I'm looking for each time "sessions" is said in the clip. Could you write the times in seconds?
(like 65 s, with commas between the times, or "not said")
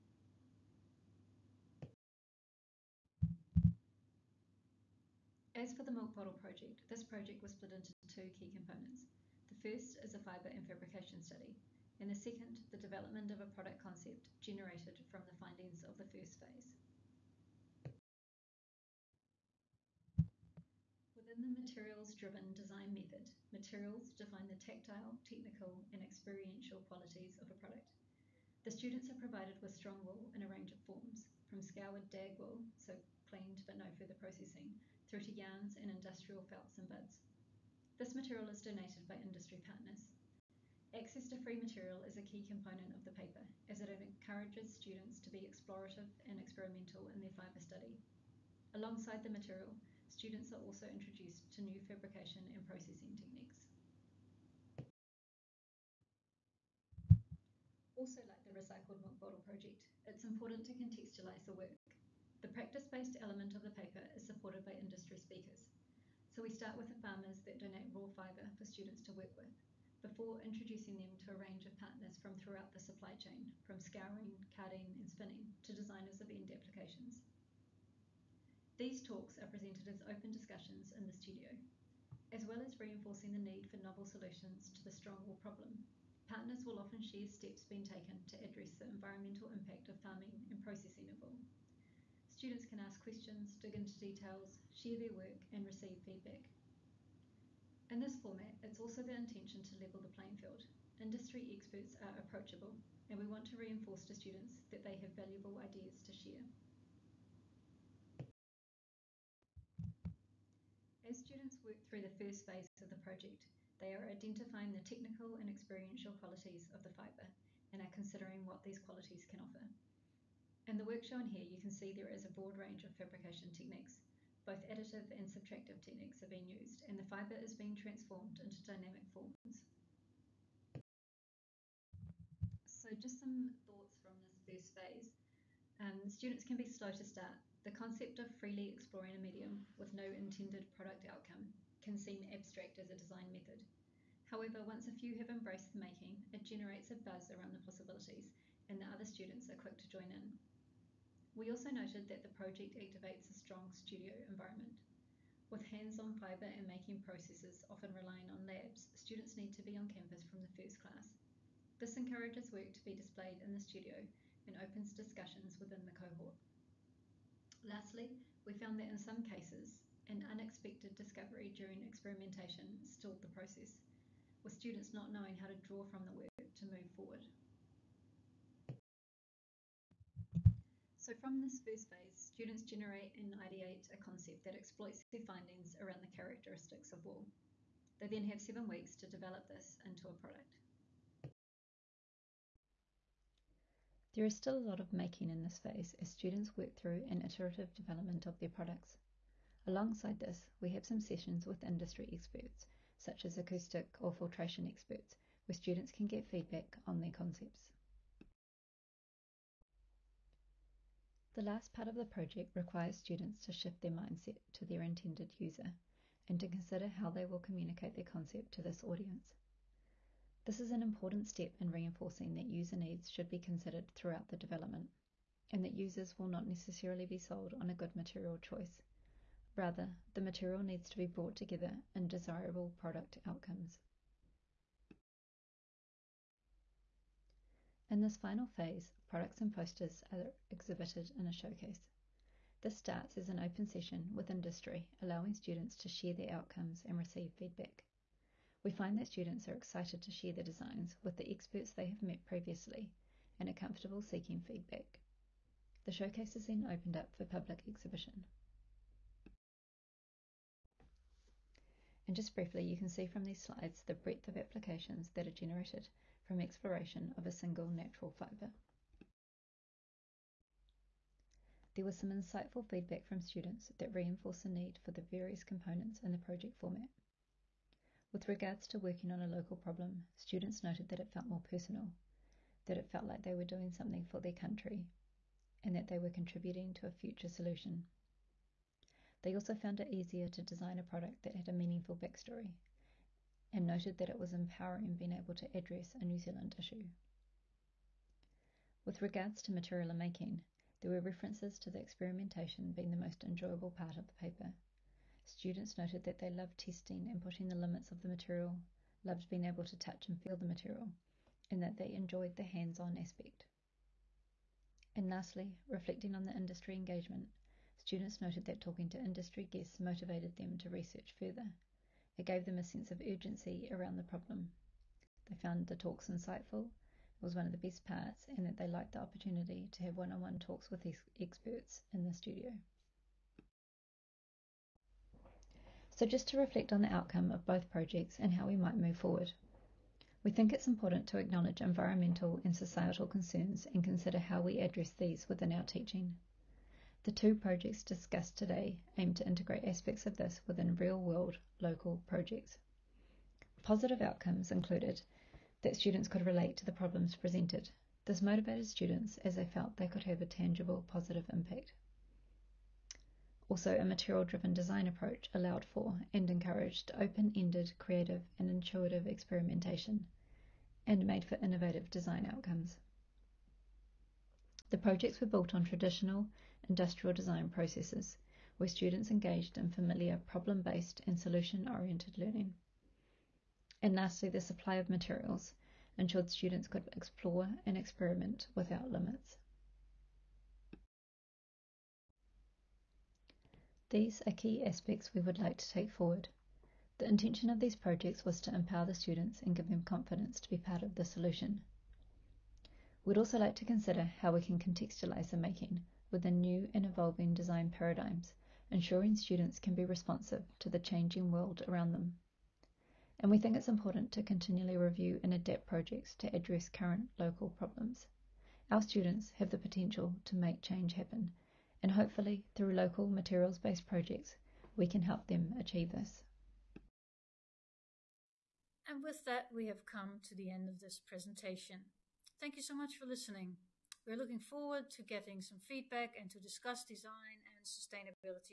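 200 s, 243 s.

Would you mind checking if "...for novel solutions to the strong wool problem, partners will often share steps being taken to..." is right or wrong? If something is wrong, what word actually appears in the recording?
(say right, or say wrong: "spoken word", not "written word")
right.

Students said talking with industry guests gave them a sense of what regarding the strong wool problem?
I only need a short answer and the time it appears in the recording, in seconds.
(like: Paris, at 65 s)
urgency, at 323 s.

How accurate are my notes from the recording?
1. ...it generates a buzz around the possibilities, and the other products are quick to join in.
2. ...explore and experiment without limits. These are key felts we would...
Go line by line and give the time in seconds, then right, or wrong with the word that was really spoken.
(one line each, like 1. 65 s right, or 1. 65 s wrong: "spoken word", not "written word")
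1. 146 s wrong: "students", not "products"
2. 386 s wrong: "aspects", not "felts".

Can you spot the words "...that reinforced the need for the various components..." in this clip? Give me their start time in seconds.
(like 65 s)
273 s.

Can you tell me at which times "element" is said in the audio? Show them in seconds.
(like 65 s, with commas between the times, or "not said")
63 s.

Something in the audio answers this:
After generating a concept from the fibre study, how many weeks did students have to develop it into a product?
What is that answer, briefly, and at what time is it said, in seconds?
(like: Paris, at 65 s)
7, at 188 s.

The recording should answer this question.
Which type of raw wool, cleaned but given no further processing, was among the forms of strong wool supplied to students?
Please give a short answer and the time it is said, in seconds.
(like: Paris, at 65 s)
scoured dag wool, at 31 s.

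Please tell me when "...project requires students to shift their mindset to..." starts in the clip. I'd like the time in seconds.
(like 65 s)
212 s.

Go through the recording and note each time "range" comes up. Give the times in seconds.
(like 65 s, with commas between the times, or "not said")
30 s, 71 s, 122 s.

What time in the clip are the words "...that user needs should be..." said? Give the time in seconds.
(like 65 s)
222 s.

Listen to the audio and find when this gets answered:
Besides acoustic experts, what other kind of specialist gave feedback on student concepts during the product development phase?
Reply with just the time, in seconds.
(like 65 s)
204 s.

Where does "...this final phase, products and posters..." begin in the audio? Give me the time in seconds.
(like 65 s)
238 s.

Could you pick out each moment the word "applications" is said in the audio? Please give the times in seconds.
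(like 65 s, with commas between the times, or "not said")
76 s, 264 s.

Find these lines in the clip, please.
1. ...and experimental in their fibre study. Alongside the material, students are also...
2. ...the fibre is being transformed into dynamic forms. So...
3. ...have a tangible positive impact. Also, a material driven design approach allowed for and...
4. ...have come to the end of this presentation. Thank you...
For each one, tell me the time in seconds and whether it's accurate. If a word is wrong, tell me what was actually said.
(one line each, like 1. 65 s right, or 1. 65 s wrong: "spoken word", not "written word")
1. 46 s right
2. 126 s right
3. 360 s right
4. 429 s right.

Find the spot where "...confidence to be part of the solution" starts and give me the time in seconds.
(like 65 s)
399 s.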